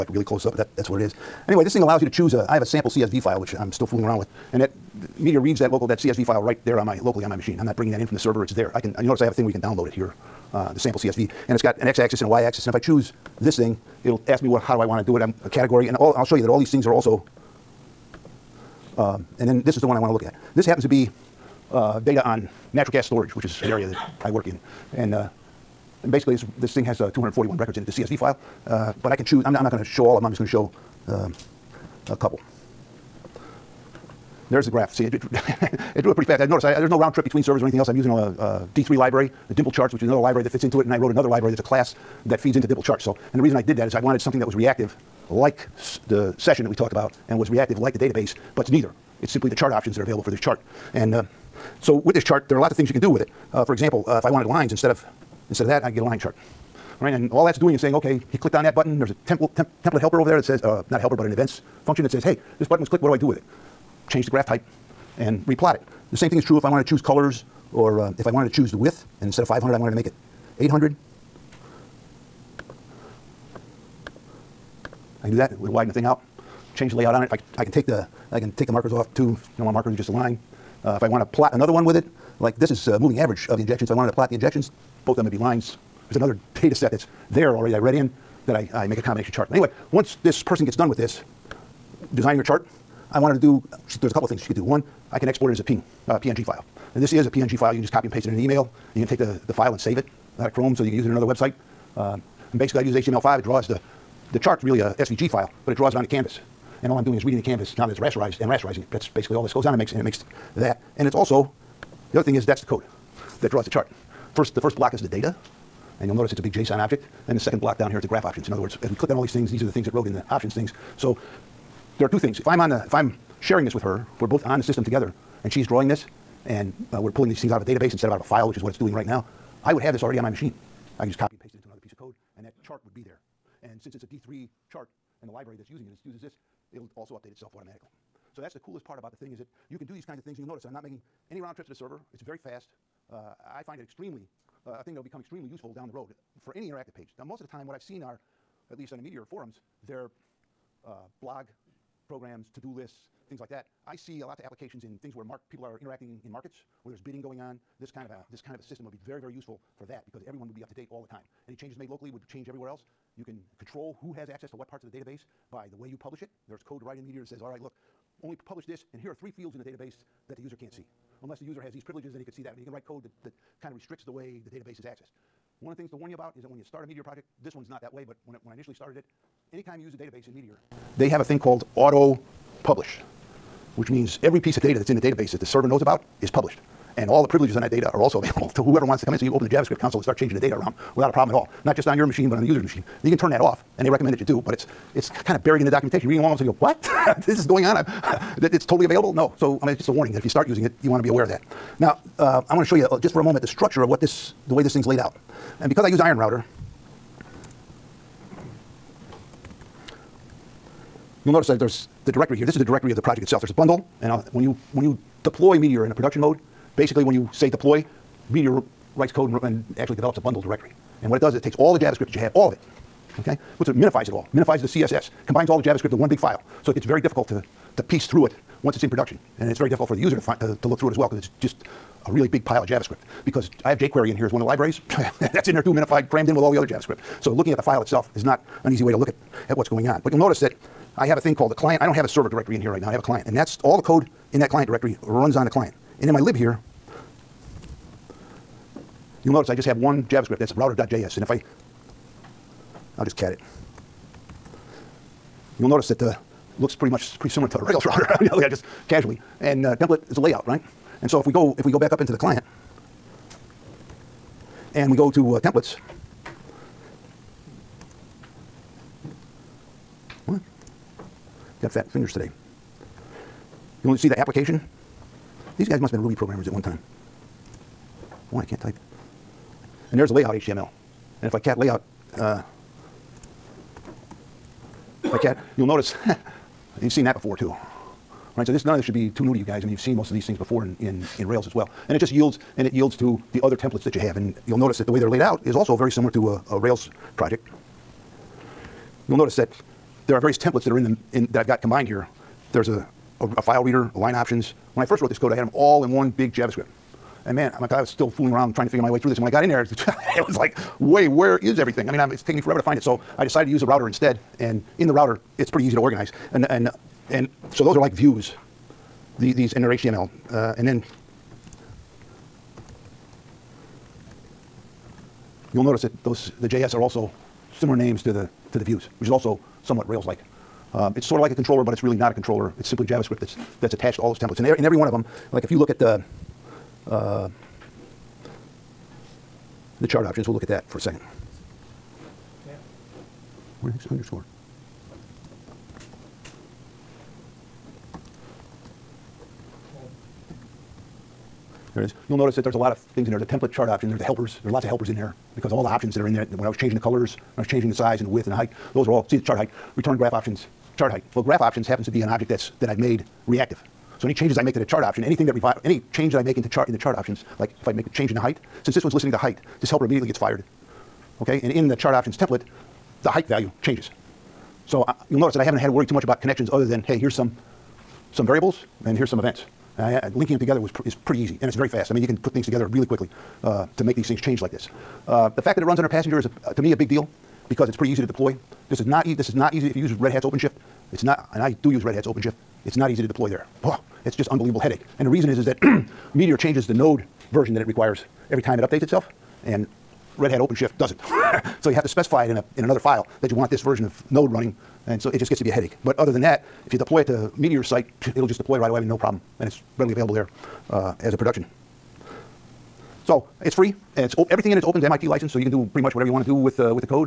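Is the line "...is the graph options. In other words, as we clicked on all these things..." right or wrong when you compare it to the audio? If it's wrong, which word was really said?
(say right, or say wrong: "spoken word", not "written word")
right.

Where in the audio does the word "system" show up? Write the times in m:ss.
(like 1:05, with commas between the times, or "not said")
2:04, 2:38.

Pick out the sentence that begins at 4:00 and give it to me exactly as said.
But you'll notice that I have a thing called the client.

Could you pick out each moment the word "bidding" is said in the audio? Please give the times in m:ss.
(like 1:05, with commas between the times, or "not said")
2:36.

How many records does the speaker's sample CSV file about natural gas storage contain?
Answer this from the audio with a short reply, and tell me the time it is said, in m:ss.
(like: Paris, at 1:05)
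241, at 0:27.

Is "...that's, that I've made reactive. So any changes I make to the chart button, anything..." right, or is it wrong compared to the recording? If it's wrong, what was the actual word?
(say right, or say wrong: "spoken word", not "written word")
wrong: "option", not "button".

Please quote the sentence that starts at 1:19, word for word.
You don't want markers, just a line.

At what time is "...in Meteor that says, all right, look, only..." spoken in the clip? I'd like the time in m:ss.
2:46.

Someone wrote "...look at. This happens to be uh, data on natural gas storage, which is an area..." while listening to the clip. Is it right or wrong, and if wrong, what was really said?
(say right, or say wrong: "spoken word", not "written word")
right.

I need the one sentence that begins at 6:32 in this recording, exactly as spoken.
It's not easy to deploy there.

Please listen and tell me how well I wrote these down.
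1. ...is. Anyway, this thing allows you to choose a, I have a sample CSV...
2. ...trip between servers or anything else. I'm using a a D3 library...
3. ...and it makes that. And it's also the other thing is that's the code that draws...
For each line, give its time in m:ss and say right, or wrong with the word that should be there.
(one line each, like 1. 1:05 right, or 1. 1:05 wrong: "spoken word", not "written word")
1. 0:00 right
2. 0:37 right
3. 1:49 right.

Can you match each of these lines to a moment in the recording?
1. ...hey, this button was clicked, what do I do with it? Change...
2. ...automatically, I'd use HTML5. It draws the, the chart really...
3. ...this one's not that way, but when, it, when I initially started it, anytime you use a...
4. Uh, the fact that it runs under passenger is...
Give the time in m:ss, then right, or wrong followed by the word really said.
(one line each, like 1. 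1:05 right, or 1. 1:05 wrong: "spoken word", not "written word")
1. 1:02 right
2. 1:42 wrong: "basically", not "automatically"
3. 2:57 right
4. 6:25 right.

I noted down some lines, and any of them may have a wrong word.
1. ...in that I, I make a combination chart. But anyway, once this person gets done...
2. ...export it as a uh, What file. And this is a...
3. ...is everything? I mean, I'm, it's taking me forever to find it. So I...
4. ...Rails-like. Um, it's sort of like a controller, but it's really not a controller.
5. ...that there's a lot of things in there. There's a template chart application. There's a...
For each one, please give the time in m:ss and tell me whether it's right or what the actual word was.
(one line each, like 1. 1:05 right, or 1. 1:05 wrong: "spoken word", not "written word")
1. 1:27 right
2. 1:35 wrong: "PNG", not "What"
3. 5:11 right
4. 5:29 right
5. 5:52 wrong: "option", not "application".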